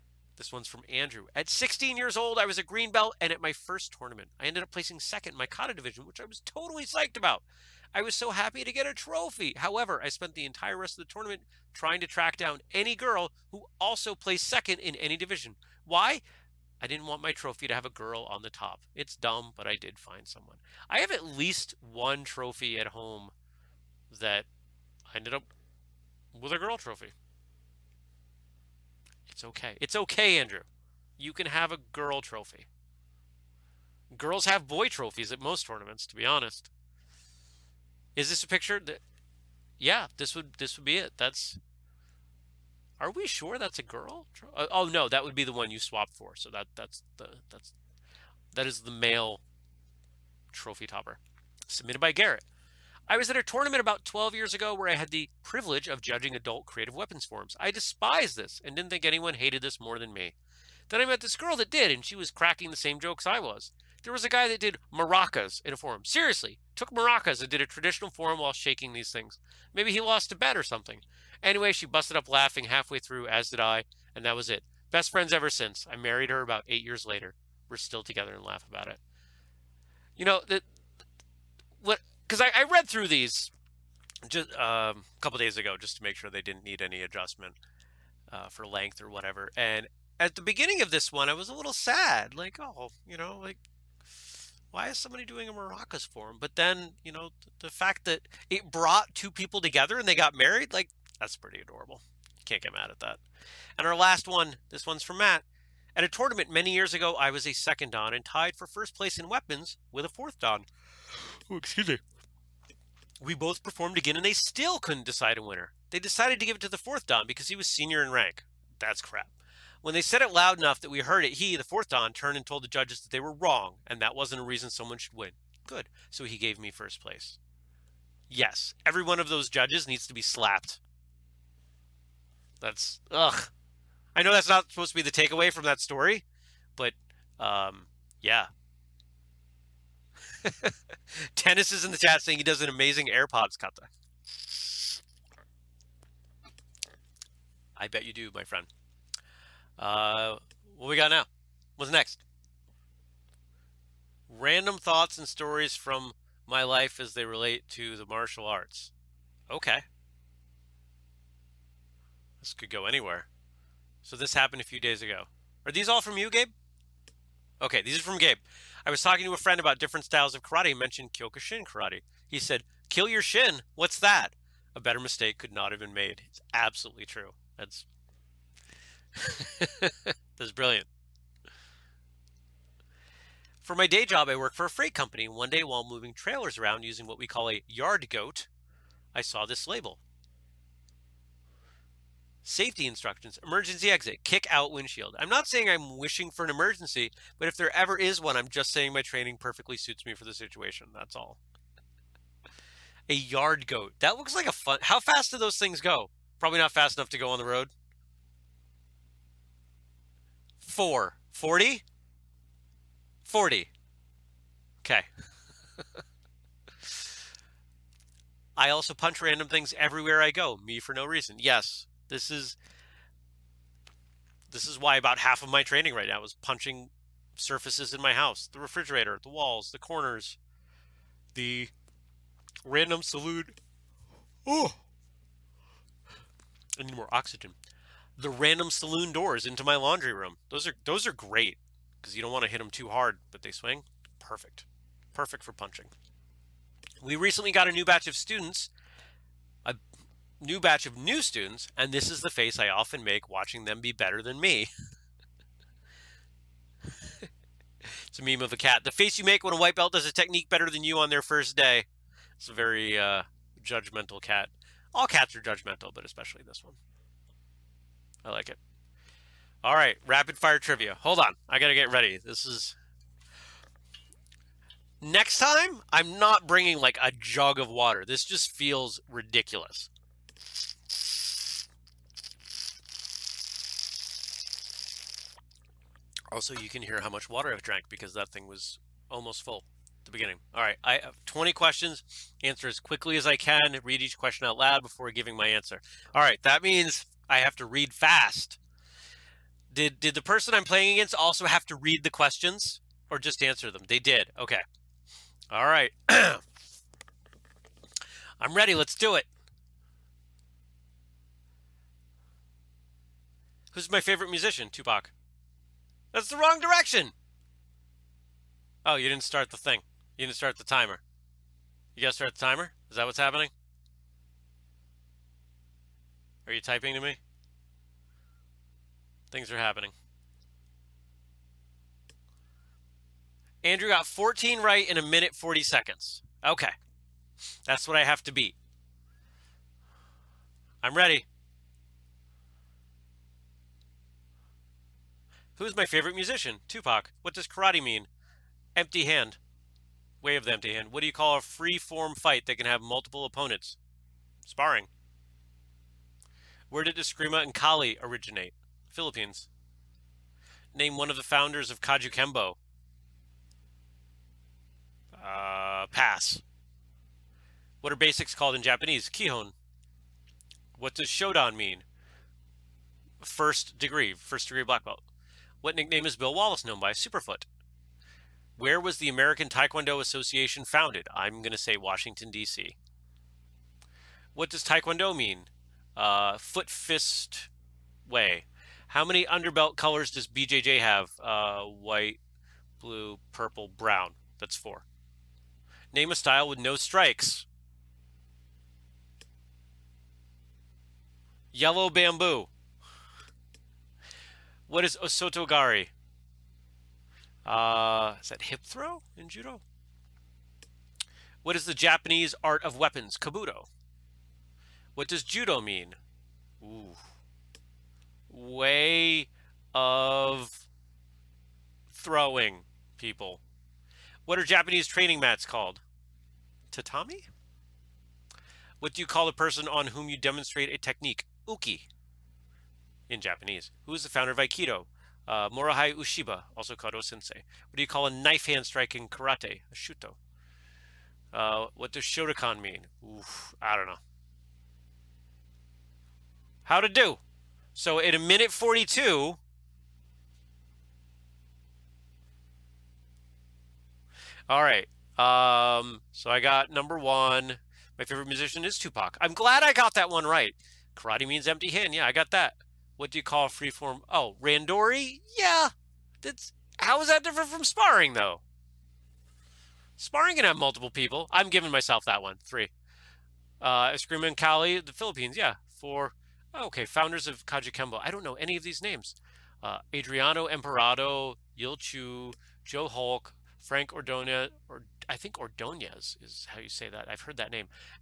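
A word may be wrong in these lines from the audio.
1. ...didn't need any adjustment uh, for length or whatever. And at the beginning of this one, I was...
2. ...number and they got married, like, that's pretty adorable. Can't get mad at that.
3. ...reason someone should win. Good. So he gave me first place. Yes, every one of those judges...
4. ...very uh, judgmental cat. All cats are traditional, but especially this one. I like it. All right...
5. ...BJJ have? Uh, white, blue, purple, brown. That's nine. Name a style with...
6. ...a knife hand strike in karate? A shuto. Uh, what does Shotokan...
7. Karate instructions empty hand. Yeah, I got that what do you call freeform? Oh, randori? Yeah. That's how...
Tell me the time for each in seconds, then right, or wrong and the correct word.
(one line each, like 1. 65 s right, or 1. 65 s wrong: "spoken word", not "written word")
1. 86 s right
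2. 99 s wrong: "together", not "number"
3. 124 s right
4. 262 s wrong: "judgmental", not "traditional"
5. 390 s wrong: "four", not "nine"
6. 438 s right
7. 460 s wrong: "means", not "instructions".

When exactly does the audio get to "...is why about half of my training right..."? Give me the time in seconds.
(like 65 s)
224 s.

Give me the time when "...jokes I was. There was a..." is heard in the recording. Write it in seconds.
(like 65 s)
62 s.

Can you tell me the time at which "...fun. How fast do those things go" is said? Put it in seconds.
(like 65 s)
204 s.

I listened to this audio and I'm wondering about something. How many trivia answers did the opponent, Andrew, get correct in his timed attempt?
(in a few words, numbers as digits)
14.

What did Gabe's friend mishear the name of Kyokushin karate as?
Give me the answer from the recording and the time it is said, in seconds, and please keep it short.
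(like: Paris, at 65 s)
Kill your shin, at 172 s.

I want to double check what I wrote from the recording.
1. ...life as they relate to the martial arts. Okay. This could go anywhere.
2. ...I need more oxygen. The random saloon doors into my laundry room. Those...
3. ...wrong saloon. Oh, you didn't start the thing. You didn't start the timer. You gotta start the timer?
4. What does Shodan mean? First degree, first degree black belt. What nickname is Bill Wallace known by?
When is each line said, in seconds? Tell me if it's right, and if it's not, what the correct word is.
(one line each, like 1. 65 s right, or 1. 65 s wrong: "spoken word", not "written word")
1. 156 s right
2. 236 s right
3. 316 s wrong: "direction", not "saloon"
4. 370 s right.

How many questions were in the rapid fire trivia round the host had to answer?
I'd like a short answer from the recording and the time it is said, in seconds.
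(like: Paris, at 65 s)
20, at 291 s.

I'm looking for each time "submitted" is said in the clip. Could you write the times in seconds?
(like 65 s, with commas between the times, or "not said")
51 s.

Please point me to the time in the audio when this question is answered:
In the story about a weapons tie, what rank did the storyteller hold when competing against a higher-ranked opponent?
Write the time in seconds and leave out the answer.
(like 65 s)
107 s.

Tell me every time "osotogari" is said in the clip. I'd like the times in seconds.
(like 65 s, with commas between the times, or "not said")
405 s.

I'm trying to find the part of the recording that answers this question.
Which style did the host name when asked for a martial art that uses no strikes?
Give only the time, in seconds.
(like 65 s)
401 s.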